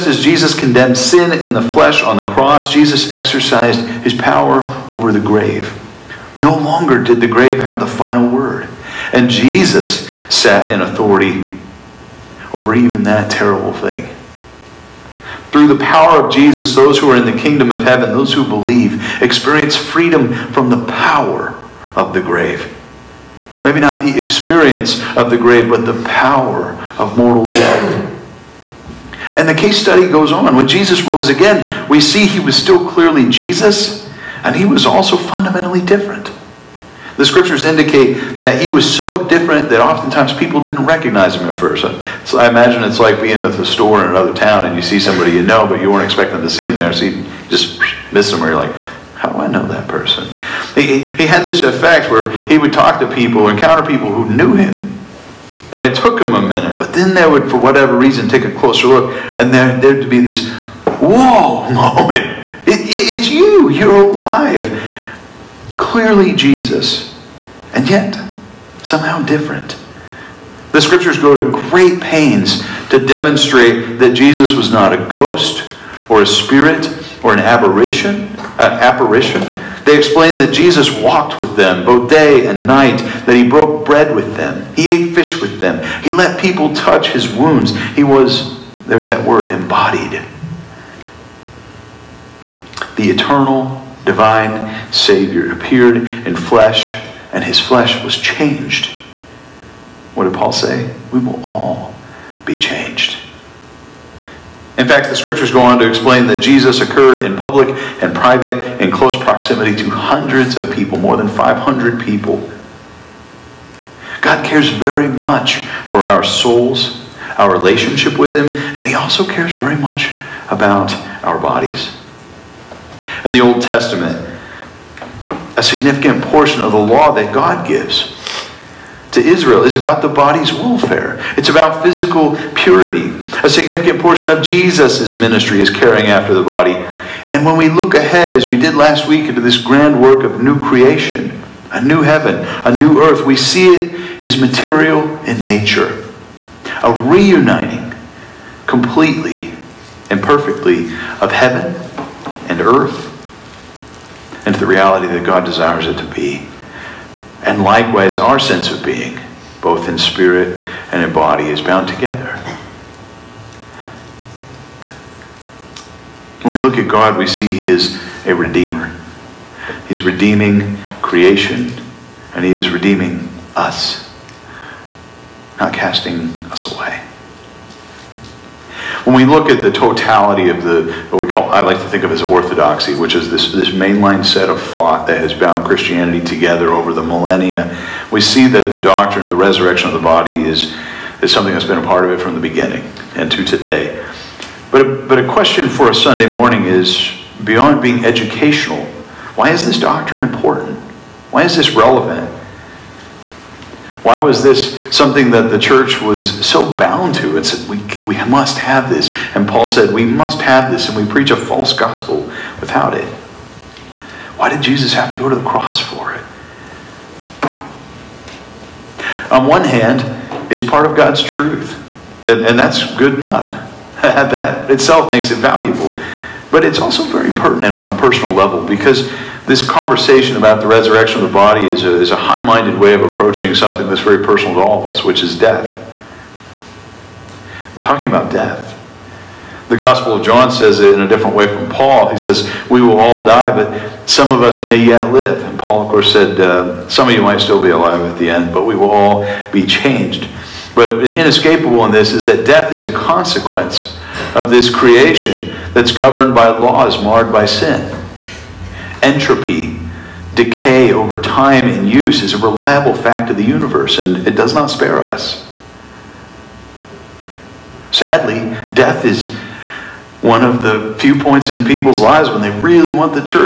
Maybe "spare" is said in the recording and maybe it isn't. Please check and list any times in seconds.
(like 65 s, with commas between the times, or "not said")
264 s.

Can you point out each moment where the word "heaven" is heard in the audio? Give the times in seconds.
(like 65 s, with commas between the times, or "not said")
17 s, 142 s, 151 s.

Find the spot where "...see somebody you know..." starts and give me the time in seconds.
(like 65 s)
44 s.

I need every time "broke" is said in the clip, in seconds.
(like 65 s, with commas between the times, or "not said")
83 s.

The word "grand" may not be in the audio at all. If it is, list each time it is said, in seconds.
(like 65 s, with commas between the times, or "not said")
139 s.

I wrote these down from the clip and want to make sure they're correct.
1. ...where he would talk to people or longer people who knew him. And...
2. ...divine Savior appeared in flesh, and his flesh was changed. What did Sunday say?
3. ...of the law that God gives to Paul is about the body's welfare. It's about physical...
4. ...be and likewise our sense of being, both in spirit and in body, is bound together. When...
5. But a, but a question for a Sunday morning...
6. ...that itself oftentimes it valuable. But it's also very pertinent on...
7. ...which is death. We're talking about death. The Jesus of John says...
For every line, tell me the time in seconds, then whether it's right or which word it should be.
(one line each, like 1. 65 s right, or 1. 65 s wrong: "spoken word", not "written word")
1. 52 s wrong: "encounter", not "longer"
2. 94 s wrong: "Paul", not "Sunday"
3. 126 s wrong: "Israel", not "Paul"
4. 156 s right
5. 194 s right
6. 224 s wrong: "makes", not "oftentimes"
7. 235 s wrong: "Gospel", not "Jesus".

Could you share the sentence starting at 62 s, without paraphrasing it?
It, it, it's you, you're alive.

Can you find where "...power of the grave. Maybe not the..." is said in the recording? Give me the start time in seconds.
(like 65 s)
20 s.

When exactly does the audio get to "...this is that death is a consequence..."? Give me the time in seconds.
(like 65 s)
251 s.